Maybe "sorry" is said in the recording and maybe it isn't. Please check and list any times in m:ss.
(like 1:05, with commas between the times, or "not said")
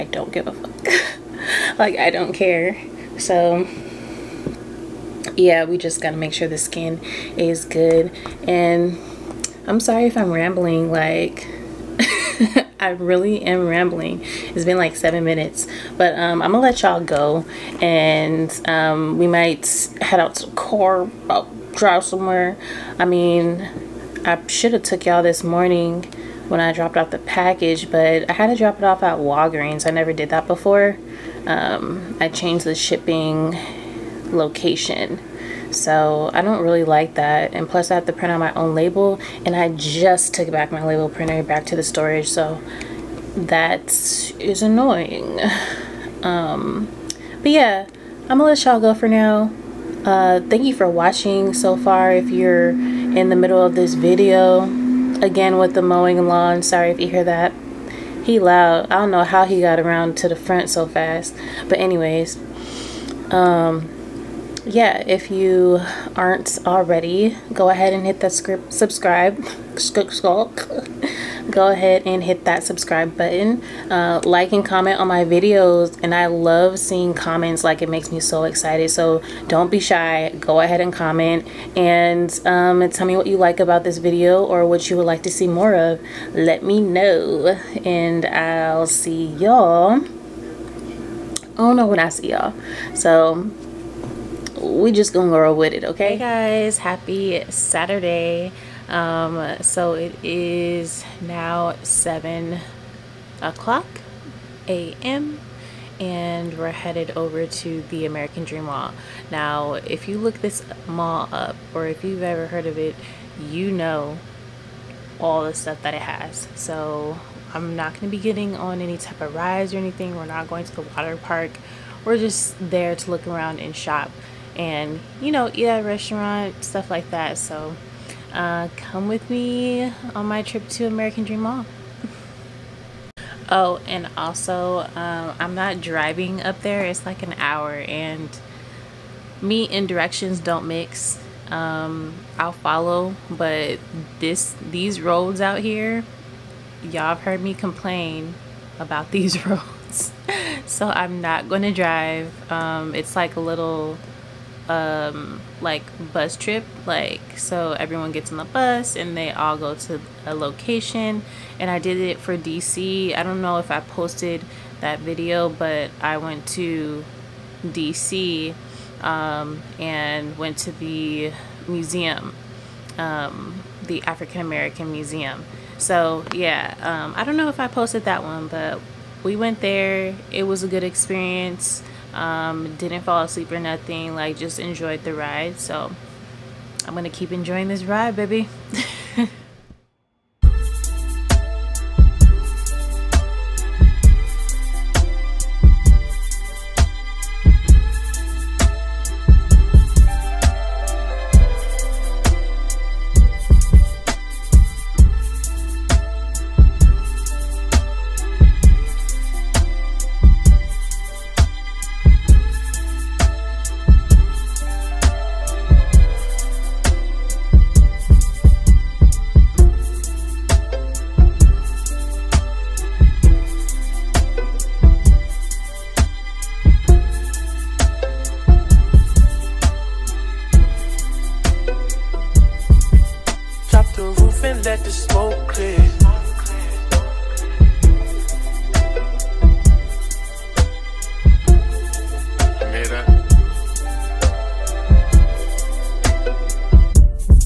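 0:09, 0:56.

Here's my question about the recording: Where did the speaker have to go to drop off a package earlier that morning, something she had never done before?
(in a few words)
Walgreens.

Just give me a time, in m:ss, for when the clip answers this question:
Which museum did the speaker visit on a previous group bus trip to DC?
2:54.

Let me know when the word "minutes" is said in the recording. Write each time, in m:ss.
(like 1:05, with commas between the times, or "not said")
0:15.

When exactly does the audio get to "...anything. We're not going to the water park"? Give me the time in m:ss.
1:59.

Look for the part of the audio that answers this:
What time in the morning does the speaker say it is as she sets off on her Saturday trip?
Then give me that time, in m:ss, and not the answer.
1:41.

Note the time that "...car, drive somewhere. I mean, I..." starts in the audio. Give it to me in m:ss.
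0:21.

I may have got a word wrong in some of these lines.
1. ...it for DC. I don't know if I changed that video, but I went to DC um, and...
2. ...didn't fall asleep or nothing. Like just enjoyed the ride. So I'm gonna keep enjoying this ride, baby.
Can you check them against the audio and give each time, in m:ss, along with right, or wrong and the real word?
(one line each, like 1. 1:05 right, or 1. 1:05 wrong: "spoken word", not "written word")
1. 2:41 wrong: "posted", not "changed"
2. 3:02 right.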